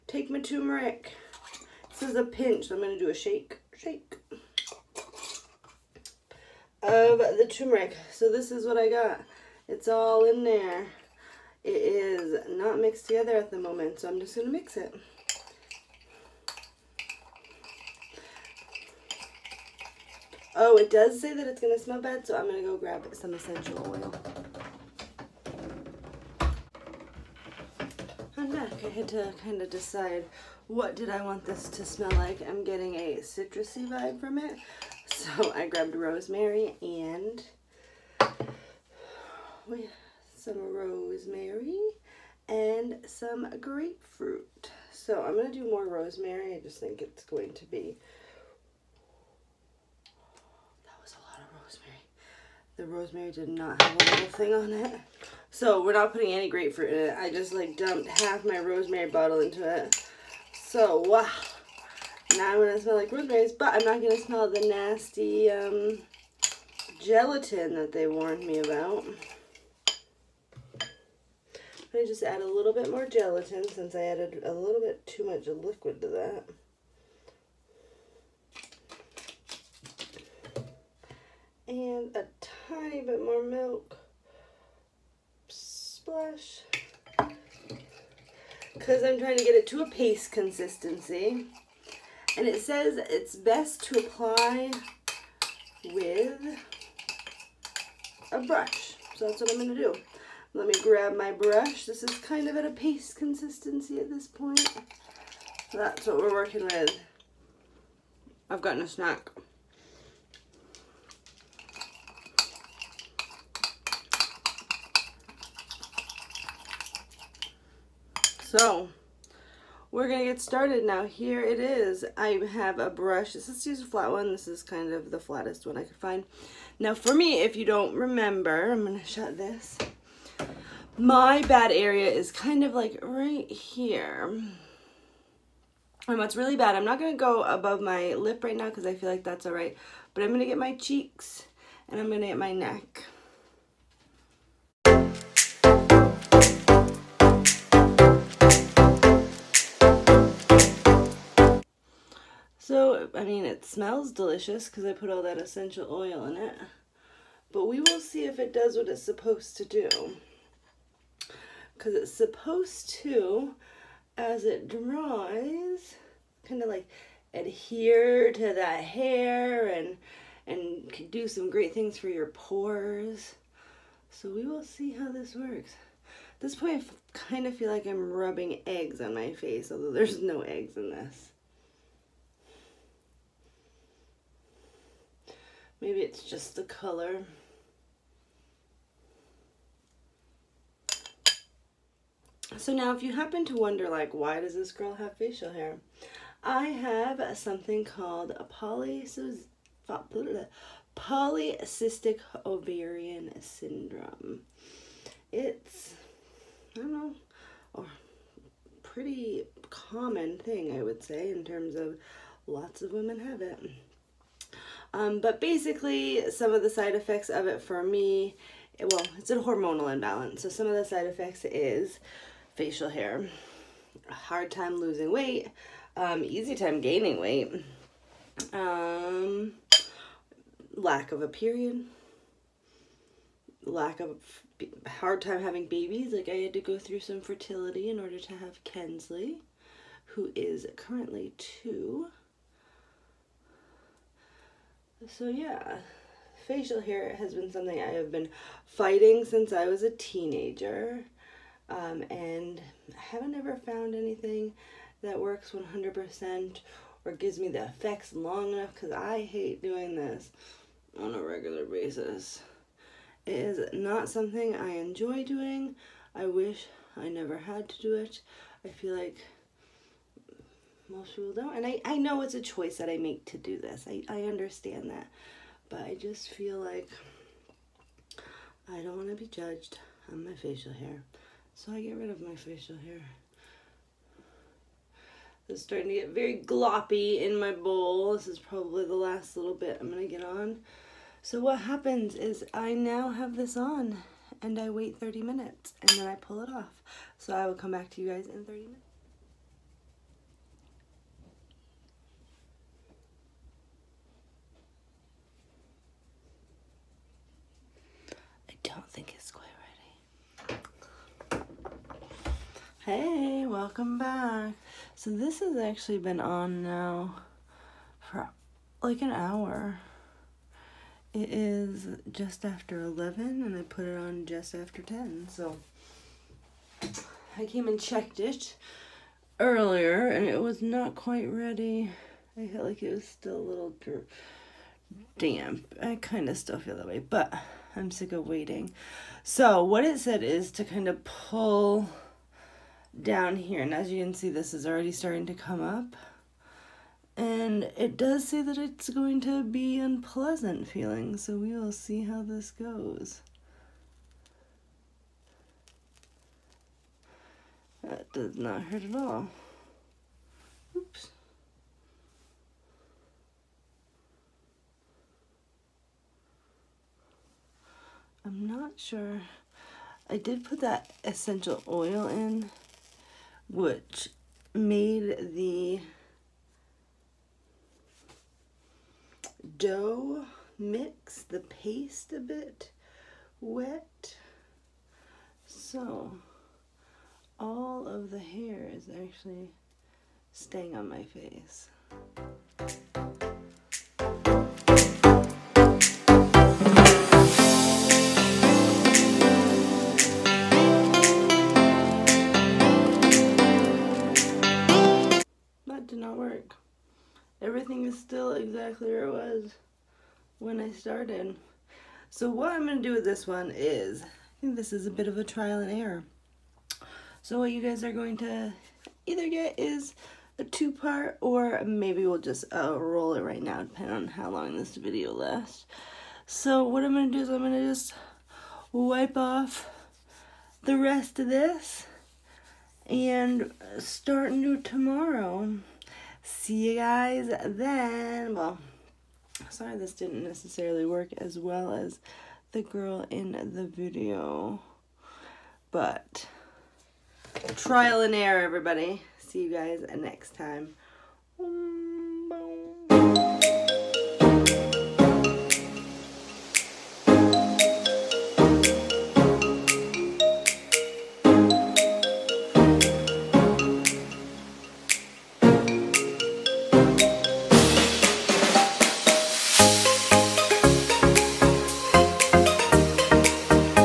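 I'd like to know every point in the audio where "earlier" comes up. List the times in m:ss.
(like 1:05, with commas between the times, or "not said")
5:29.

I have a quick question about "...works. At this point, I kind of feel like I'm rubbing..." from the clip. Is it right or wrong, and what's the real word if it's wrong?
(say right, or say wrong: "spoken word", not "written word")
right.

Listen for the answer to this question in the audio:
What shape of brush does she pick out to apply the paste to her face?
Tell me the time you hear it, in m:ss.
2:03.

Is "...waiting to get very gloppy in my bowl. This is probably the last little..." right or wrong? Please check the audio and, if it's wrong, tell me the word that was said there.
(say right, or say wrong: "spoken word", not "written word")
wrong: "starting", not "waiting".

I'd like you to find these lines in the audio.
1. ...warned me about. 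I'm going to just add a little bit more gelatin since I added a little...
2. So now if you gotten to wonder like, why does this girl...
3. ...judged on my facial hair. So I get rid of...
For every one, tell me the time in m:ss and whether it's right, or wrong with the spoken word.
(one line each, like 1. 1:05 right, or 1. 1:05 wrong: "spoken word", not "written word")
1. 1:08 right
2. 3:12 wrong: "happen", not "gotten"
3. 4:39 right.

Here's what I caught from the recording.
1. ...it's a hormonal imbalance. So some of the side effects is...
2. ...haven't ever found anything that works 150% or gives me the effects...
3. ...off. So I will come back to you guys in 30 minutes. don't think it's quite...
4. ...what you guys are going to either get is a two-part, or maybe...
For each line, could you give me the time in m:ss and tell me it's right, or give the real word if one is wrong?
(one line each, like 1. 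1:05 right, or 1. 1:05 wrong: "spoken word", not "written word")
1. 3:39 right
2. 4:12 wrong: "100", not "150"
3. 4:56 right
4. 6:57 right.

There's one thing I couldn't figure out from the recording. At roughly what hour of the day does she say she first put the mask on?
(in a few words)
just after 10.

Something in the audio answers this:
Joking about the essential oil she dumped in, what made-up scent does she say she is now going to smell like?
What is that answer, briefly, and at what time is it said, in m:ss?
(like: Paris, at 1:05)
roseberries, at 1:03.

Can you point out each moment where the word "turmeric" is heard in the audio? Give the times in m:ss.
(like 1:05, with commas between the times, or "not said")
0:00, 0:07.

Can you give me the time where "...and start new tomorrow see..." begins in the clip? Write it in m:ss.
7:12.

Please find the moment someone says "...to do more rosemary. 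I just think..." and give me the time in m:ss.
0:45.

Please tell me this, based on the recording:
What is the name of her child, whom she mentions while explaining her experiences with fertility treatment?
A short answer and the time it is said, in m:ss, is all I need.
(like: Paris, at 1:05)
Kensley, at 3:58.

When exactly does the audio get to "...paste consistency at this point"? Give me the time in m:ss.
1:42.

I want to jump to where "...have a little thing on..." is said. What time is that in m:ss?
0:53.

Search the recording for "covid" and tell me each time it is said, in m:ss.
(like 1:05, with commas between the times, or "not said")
not said.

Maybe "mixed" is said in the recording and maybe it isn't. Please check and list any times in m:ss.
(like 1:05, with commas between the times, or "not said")
0:12.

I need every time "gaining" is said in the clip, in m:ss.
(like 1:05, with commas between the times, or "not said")
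3:46.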